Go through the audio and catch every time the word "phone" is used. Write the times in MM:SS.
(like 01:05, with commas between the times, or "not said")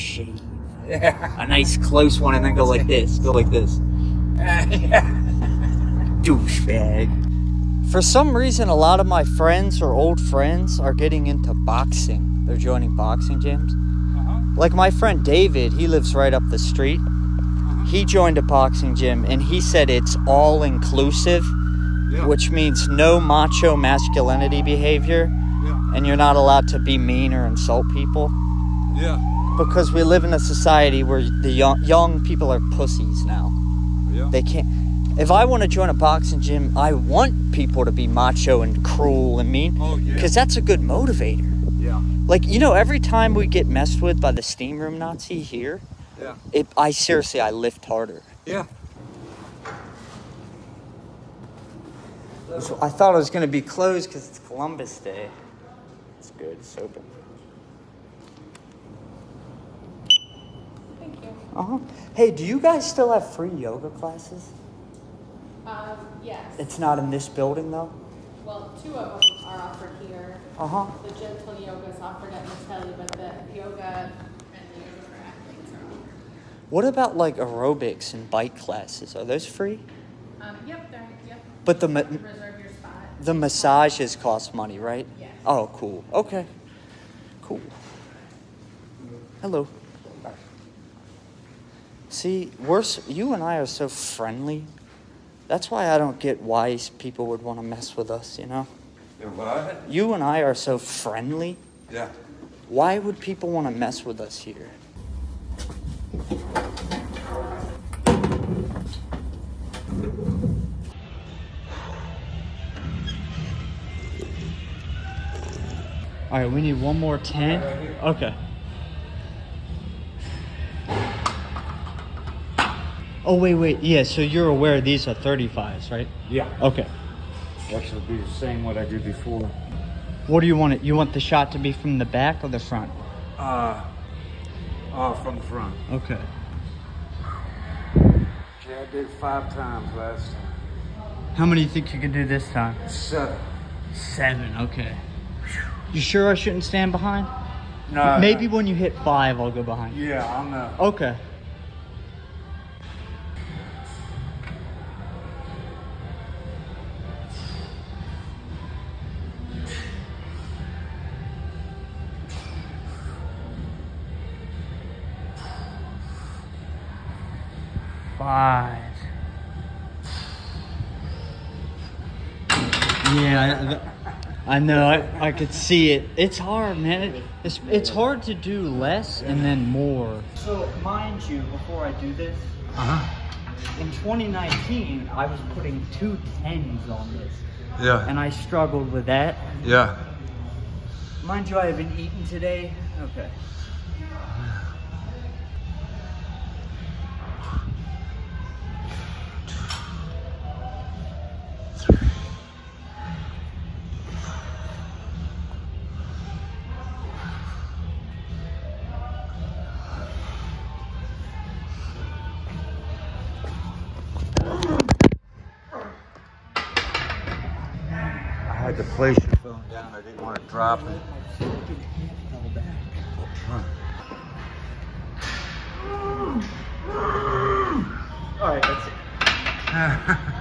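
03:39.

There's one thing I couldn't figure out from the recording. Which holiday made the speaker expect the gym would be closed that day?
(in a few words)
Columbus Day.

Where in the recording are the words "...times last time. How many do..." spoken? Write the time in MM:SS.
02:19.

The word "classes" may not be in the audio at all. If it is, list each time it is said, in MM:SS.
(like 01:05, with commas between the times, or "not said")
01:03, 01:18.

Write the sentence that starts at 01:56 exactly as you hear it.
All right, we need one more tent.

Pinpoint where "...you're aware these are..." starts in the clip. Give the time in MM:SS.
02:04.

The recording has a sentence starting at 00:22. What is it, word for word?
which means no macho masculinity behavior.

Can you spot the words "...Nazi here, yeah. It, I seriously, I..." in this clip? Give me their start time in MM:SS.
00:44.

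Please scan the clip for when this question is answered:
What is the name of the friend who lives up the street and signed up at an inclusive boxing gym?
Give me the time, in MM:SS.
00:15.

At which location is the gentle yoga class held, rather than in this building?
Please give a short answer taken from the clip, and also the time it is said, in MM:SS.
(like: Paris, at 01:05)
Mattelli, at 01:12.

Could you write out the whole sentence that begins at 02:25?
You sure I shouldn't stand behind?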